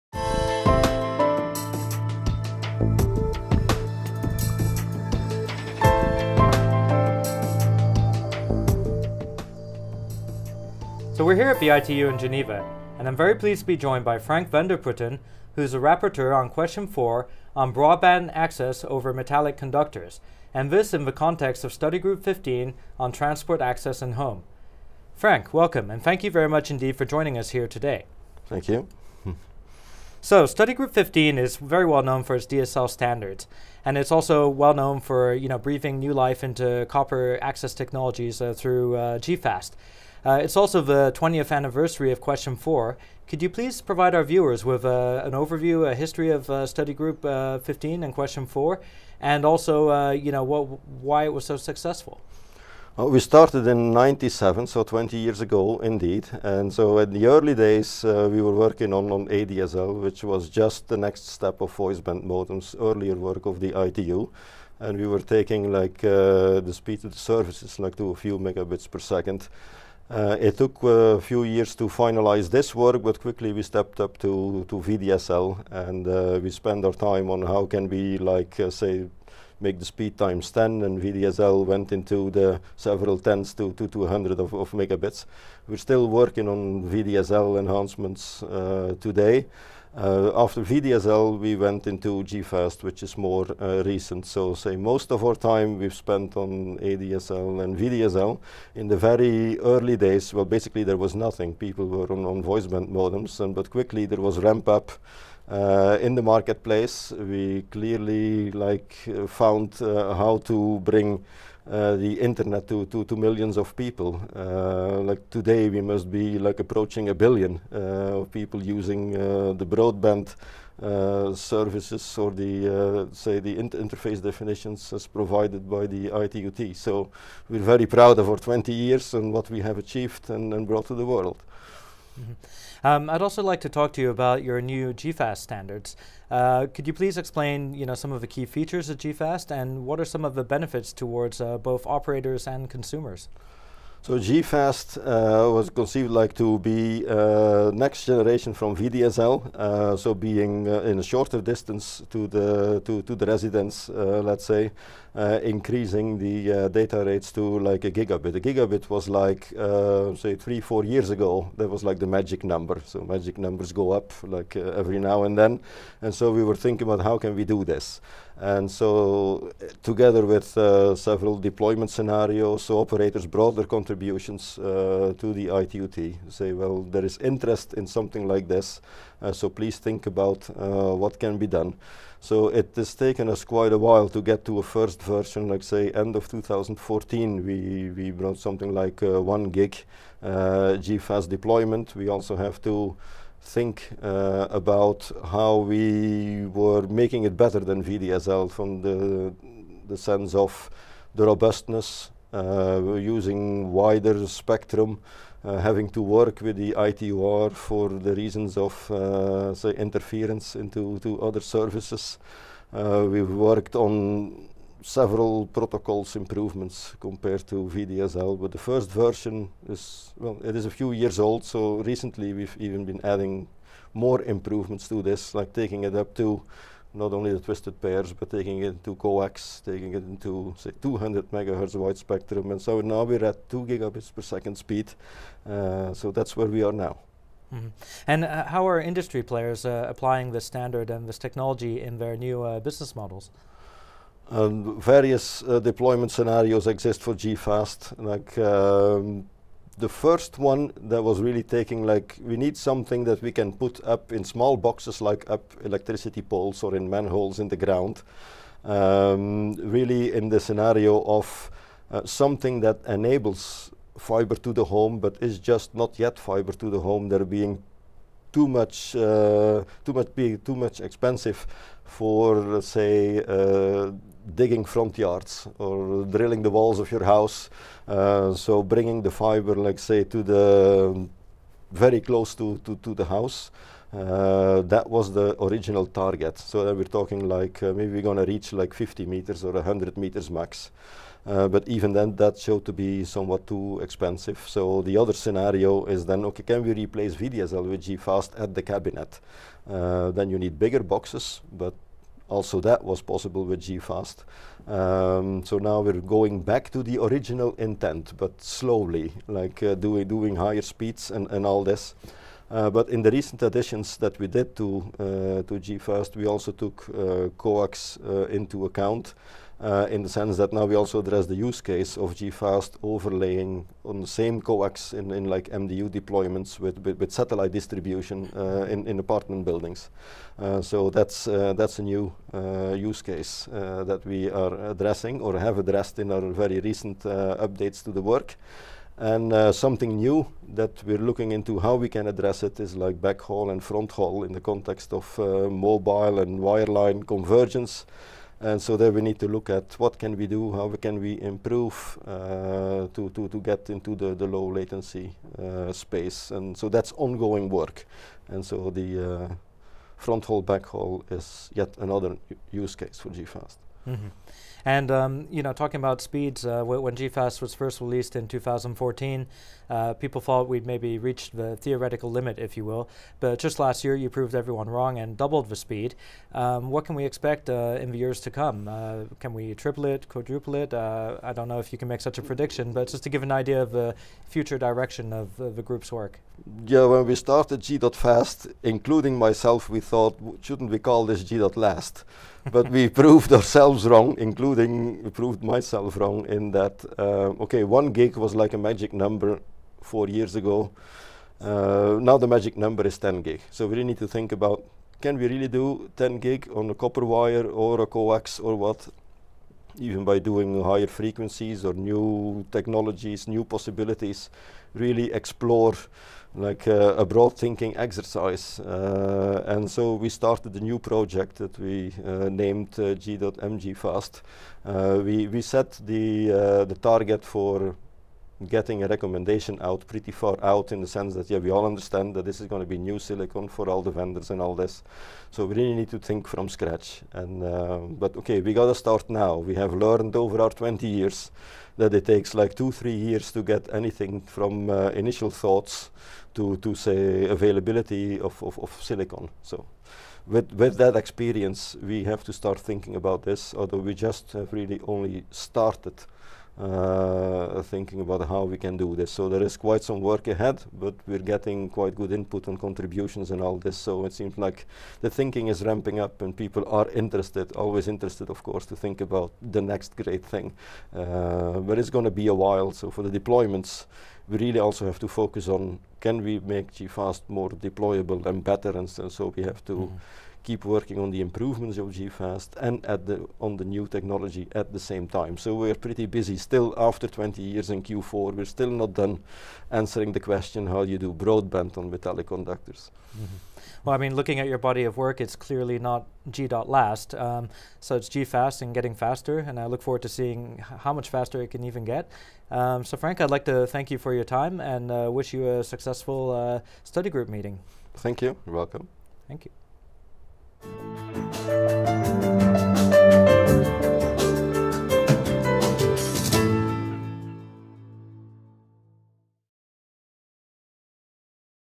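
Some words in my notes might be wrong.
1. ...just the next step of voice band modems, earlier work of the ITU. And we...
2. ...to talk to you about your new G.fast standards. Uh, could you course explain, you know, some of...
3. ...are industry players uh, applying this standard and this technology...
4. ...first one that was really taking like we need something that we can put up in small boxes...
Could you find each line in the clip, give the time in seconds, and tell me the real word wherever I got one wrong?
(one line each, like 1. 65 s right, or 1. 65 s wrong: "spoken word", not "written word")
1. 60 s right
2. 133 s wrong: "please", not "course"
3. 238 s right
4. 249 s right.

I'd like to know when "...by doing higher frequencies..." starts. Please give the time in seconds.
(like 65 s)
410 s.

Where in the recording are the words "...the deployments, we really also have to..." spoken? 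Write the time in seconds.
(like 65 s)
473 s.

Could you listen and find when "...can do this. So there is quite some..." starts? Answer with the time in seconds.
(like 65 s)
458 s.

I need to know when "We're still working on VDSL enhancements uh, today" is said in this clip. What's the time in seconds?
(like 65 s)
85 s.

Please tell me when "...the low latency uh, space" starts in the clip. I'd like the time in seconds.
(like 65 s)
354 s.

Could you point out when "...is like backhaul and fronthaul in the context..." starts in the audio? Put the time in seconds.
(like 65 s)
342 s.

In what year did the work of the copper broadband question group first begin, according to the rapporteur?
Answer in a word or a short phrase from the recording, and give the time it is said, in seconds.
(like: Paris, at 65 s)
1997, at 53 s.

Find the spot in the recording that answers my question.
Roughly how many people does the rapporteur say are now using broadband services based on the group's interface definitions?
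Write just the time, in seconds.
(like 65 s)
117 s.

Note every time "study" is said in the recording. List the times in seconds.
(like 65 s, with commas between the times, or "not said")
21 s, 30 s, 46 s, 506 s.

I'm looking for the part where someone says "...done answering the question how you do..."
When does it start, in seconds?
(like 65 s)
488 s.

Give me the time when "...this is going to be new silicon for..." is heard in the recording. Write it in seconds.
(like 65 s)
432 s.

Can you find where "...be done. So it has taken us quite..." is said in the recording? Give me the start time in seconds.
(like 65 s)
181 s.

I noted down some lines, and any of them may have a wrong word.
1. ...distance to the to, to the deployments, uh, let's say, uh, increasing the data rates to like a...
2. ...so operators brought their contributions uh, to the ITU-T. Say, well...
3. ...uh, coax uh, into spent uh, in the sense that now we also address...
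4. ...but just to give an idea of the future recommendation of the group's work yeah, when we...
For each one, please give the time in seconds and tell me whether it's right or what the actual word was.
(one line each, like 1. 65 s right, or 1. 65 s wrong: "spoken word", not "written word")
1. 151 s wrong: "residents", not "deployments"
2. 172 s right
3. 316 s wrong: "account", not "spent"
4. 382 s wrong: "direction", not "recommendation".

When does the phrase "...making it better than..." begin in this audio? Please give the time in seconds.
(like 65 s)
196 s.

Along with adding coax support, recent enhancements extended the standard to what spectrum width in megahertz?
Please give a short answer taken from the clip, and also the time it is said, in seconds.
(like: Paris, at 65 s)
200 megahertz, at 230 s.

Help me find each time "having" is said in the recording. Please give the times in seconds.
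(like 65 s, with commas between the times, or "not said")
205 s.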